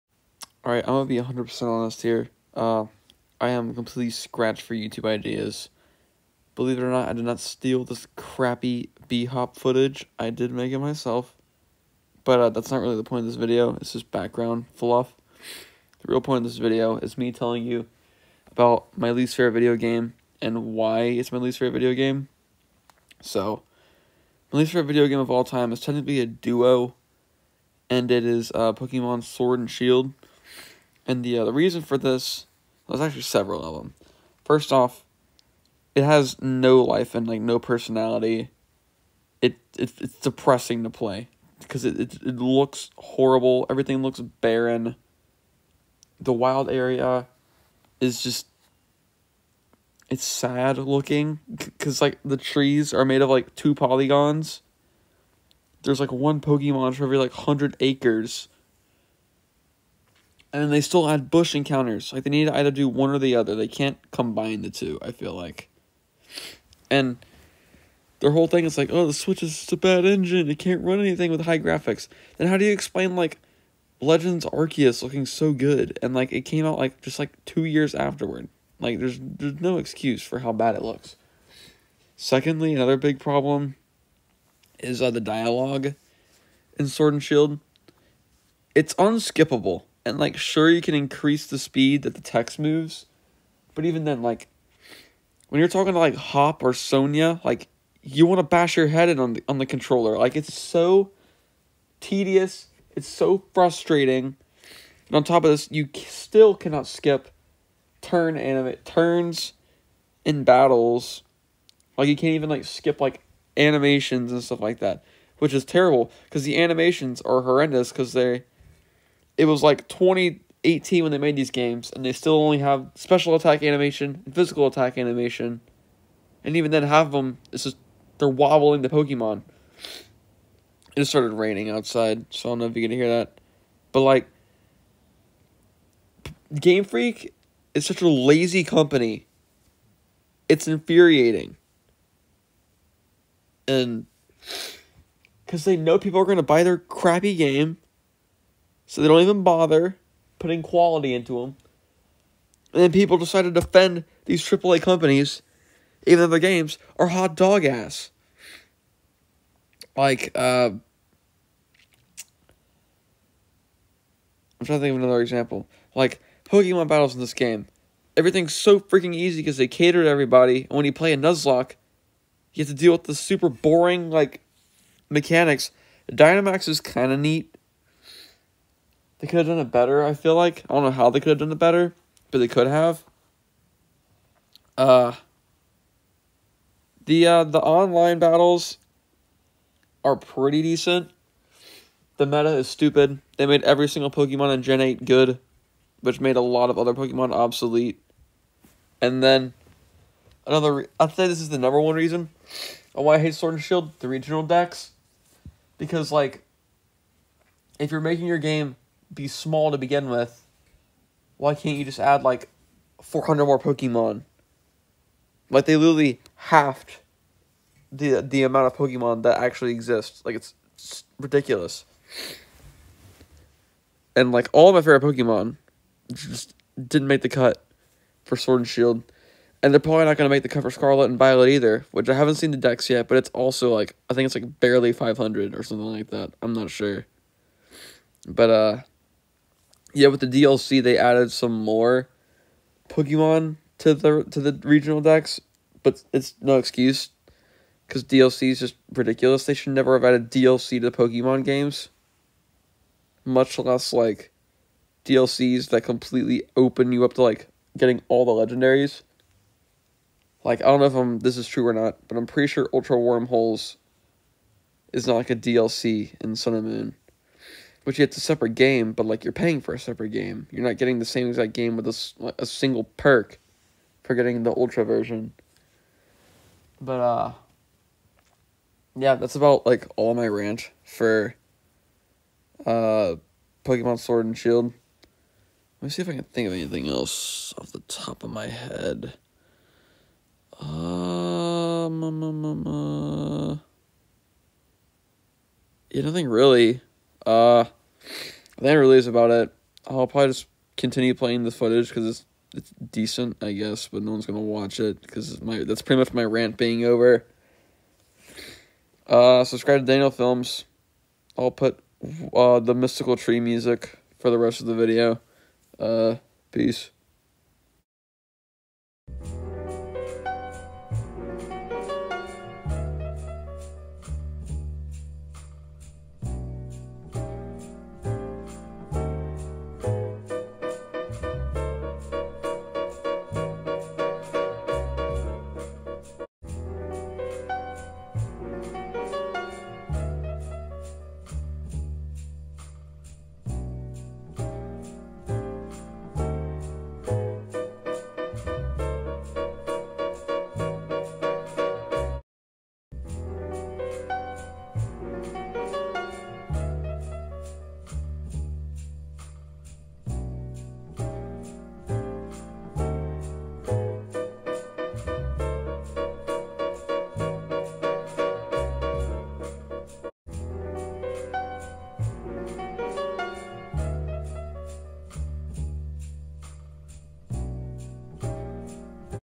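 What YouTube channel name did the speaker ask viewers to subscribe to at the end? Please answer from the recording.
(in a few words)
Daniel Films.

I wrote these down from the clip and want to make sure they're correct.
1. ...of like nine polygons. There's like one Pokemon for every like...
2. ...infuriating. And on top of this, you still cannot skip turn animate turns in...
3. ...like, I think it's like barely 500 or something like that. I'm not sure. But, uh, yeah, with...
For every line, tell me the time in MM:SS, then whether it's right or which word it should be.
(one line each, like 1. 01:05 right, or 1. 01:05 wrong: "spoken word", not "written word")
1. 00:53 wrong: "two", not "nine"
2. 01:43 wrong: "frustrating", not "infuriating"
3. 03:53 right.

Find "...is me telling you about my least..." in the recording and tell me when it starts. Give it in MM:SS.
00:16.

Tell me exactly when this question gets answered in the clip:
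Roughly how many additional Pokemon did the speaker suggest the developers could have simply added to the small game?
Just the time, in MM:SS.
03:33.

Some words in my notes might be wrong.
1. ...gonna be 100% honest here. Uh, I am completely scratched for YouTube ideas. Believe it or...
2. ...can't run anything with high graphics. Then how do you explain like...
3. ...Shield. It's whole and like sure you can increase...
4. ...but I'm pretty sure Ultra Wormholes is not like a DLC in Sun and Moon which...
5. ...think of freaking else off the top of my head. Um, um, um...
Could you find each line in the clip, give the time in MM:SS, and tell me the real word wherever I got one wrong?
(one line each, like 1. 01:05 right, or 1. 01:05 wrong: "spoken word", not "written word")
1. 00:00 right
2. 01:10 right
3. 01:27 wrong: "unskippable", not "whole"
4. 04:22 right
5. 04:46 wrong: "anything", not "freaking".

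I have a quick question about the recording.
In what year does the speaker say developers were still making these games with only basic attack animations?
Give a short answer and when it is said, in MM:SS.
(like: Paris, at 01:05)
2018, at 01:59.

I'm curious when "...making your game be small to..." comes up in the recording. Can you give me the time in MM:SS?
03:28.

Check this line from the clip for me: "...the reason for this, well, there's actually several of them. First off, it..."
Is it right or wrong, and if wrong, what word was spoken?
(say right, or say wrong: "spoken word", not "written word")
right.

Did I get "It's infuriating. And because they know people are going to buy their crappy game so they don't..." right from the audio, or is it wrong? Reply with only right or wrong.
right.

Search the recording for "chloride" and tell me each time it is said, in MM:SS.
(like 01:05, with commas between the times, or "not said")
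not said.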